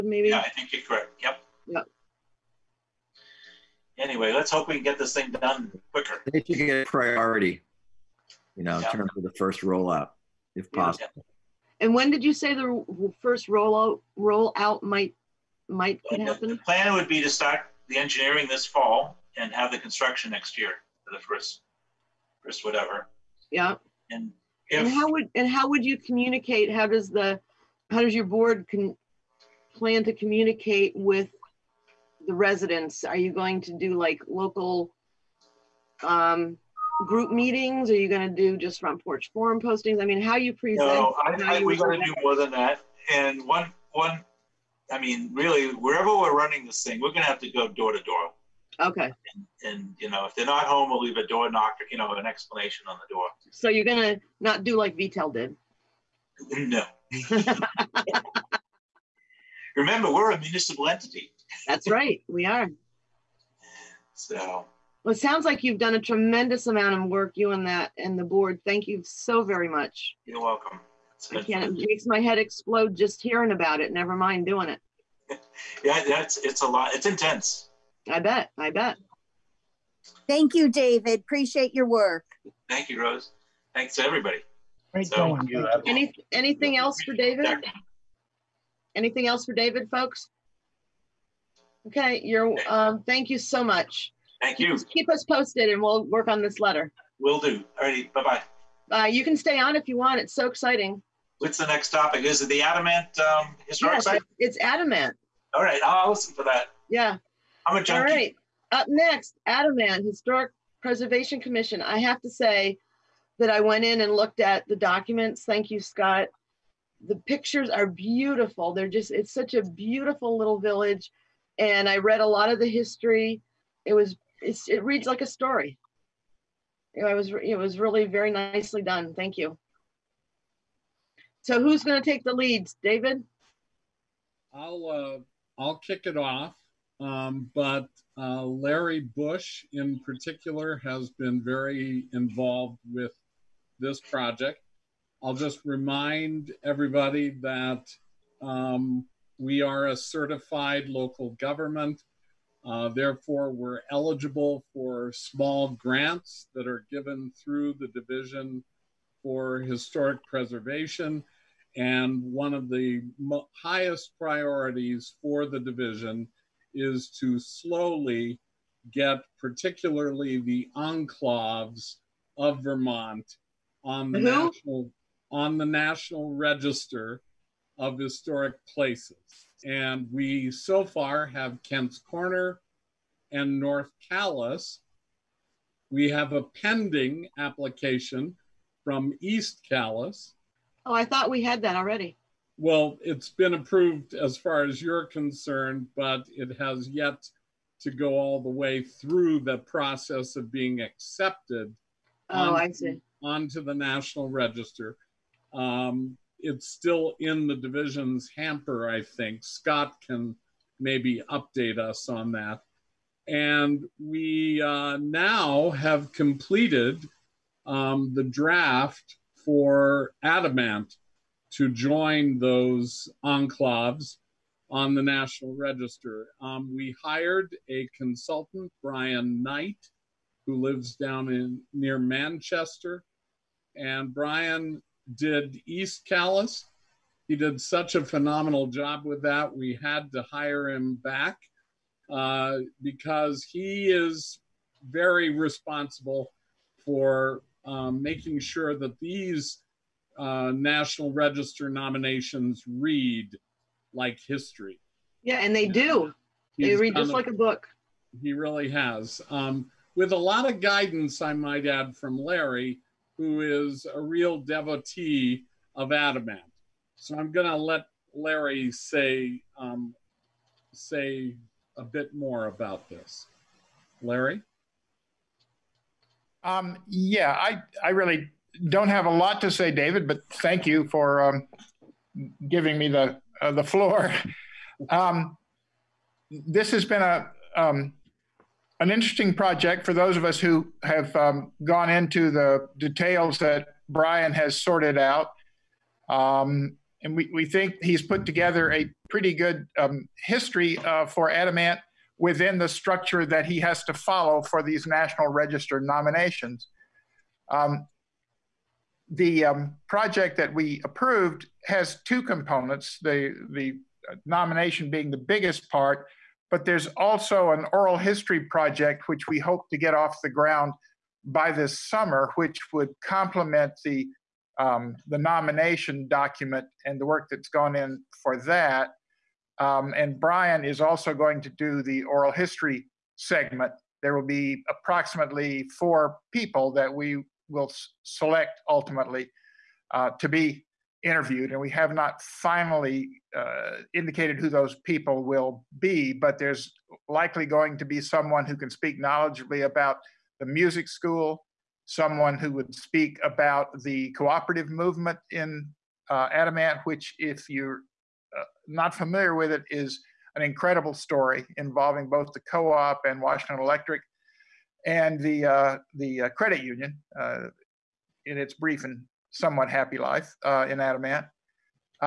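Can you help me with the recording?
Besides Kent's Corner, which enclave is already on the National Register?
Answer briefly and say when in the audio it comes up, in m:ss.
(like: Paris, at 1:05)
North Calais, at 3:03.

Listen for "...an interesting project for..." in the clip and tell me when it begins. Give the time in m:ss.
4:48.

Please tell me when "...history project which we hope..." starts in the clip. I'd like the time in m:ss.
5:17.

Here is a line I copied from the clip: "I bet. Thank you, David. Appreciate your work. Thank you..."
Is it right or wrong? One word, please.
right.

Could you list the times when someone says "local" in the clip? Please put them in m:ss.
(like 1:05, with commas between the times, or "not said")
0:34, 2:30.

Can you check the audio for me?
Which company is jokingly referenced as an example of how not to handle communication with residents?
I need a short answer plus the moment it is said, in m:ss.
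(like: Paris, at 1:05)
VTEL, at 0:54.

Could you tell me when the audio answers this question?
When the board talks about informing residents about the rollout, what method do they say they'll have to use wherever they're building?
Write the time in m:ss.
0:47.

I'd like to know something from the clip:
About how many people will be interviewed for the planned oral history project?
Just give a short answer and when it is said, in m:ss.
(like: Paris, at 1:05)
4, at 5:35.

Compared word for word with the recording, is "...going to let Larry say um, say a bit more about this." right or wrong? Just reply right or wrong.
right.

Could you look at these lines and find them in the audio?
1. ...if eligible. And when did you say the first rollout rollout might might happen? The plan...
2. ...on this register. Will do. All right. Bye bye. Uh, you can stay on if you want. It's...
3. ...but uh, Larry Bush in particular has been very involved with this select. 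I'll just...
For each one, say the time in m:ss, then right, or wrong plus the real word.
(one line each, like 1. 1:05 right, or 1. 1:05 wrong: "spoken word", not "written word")
1. 0:10 wrong: "possible", not "eligible"
2. 1:36 wrong: "letter", not "register"
3. 2:17 wrong: "project", not "select".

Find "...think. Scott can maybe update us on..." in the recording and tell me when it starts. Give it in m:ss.
3:29.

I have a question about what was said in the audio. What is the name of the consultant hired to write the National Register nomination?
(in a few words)
Brian Knight.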